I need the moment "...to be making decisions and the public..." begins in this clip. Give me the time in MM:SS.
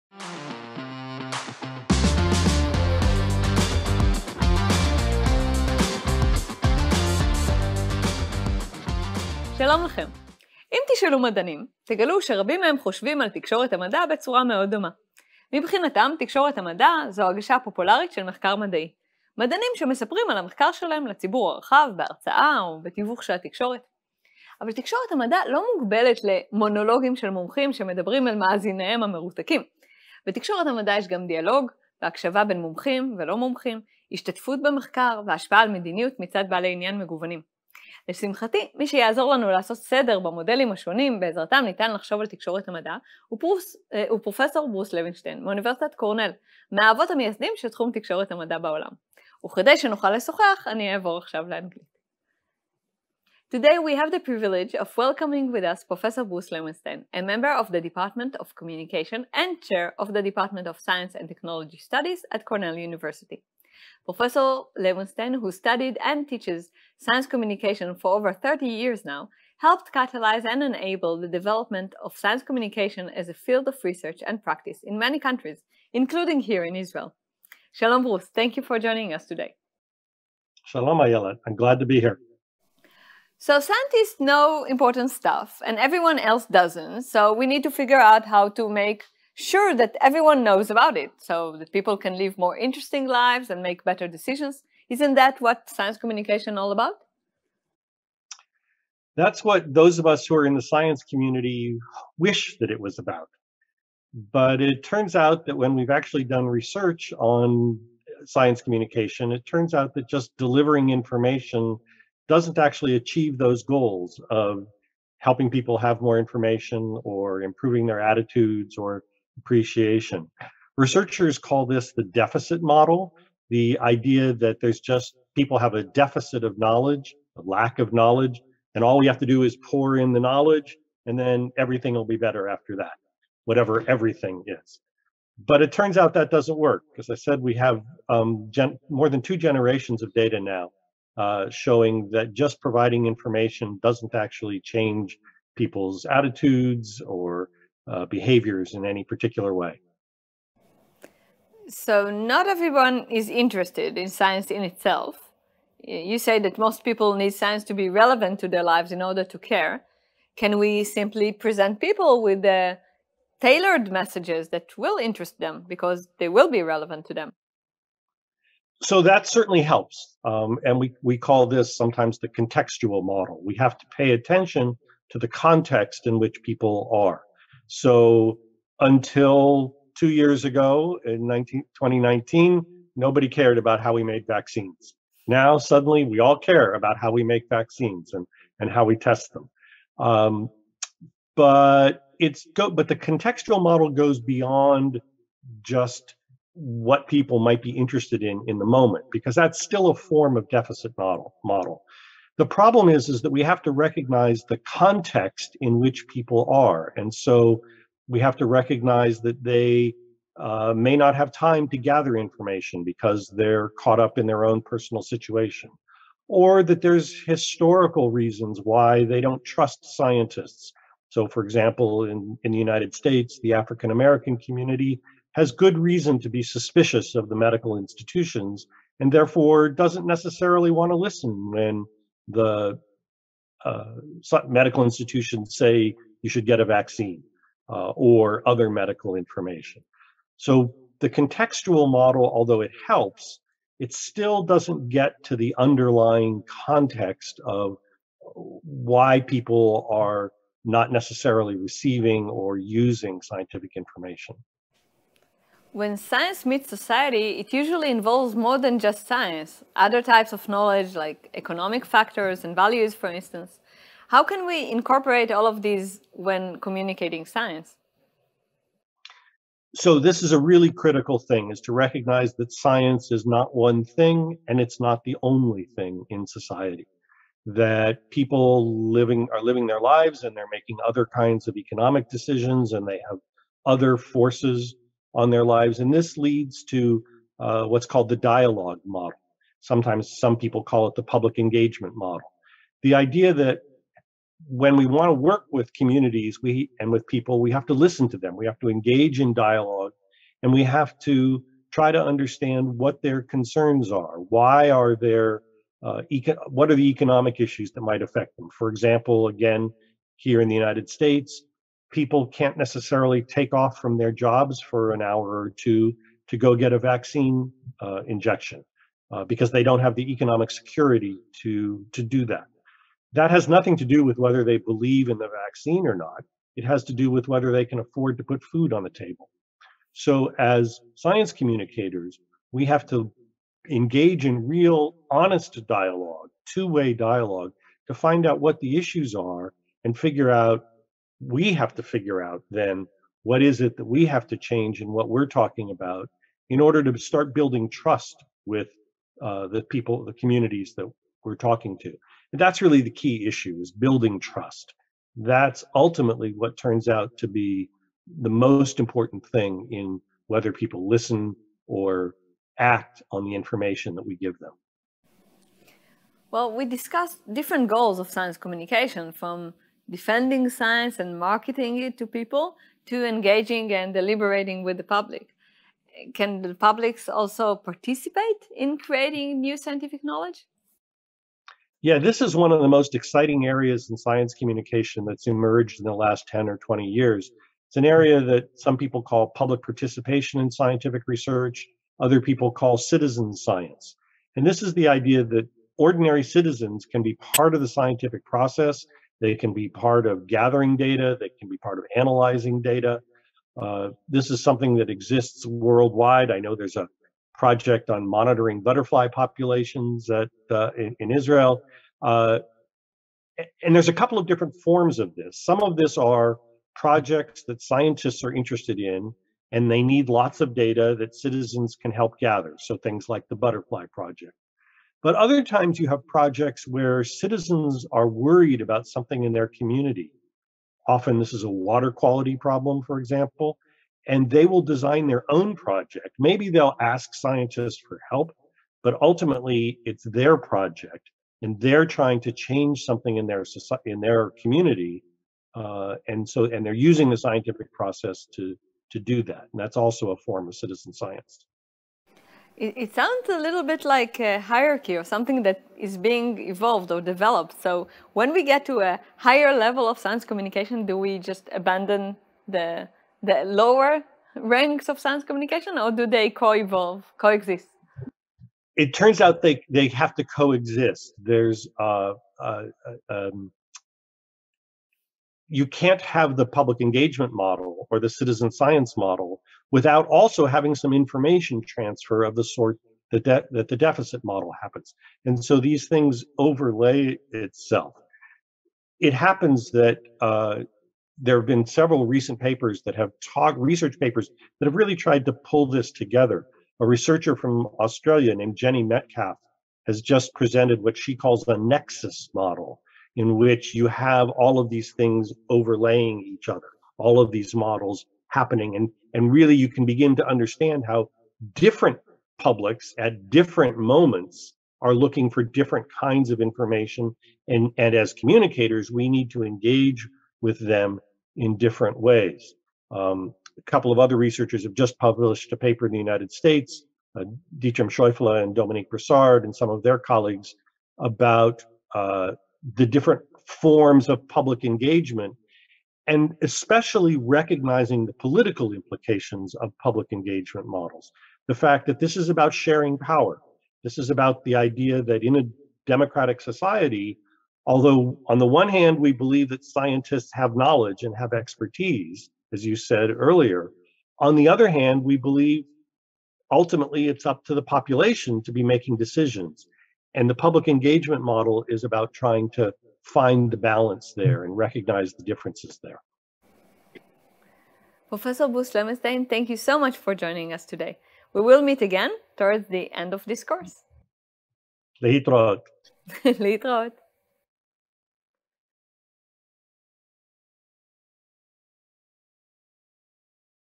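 09:18.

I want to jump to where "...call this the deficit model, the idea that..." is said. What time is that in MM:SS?
02:01.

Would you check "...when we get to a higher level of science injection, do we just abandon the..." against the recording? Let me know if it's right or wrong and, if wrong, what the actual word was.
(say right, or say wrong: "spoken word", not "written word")
wrong: "communication", not "injection".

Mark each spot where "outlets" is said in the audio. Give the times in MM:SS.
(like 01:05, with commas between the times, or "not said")
not said.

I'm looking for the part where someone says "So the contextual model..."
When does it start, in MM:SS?
04:00.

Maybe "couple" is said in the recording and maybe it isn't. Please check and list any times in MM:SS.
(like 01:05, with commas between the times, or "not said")
06:54, 08:43.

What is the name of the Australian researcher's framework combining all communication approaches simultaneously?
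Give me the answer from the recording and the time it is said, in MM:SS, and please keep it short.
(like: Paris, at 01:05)
nexus model, at 08:21.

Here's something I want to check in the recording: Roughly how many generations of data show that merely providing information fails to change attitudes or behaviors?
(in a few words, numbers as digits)
more than two generations.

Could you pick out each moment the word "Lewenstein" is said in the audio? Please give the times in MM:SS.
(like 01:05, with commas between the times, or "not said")
09:28.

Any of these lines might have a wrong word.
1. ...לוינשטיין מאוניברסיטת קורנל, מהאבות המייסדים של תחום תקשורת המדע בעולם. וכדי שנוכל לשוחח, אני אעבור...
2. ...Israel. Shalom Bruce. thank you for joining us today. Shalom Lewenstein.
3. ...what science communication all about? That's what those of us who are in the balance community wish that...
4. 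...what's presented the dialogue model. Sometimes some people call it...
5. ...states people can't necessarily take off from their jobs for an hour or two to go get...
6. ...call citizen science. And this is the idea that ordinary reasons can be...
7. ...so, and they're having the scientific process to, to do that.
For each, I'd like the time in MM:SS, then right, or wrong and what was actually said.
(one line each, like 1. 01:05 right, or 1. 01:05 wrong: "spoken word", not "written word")
1. 00:44 right
2. 01:16 wrong: "Ayelet", not "Lewenstein"
3. 01:35 wrong: "science", not "balance"
4. 04:47 wrong: "called", not "presented"
5. 05:10 right
6. 06:32 wrong: "citizens", not "reasons"
7. 07:26 wrong: "using", not "having".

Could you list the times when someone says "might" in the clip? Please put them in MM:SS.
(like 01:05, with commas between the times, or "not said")
03:17, 05:07.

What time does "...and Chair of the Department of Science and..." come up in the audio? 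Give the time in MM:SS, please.
00:59.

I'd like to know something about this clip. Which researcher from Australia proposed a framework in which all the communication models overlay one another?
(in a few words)
Jenni Metcalfe.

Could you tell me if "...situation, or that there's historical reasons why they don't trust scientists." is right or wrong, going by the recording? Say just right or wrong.
right.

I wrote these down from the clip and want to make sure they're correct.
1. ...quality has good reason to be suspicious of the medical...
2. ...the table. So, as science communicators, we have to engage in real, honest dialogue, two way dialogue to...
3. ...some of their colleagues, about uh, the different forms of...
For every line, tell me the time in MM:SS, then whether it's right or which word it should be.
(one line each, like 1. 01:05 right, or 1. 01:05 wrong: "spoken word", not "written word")
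1. 03:44 wrong: "community", not "quality"
2. 05:28 right
3. 08:49 right.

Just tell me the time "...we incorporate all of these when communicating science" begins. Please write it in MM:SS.
04:24.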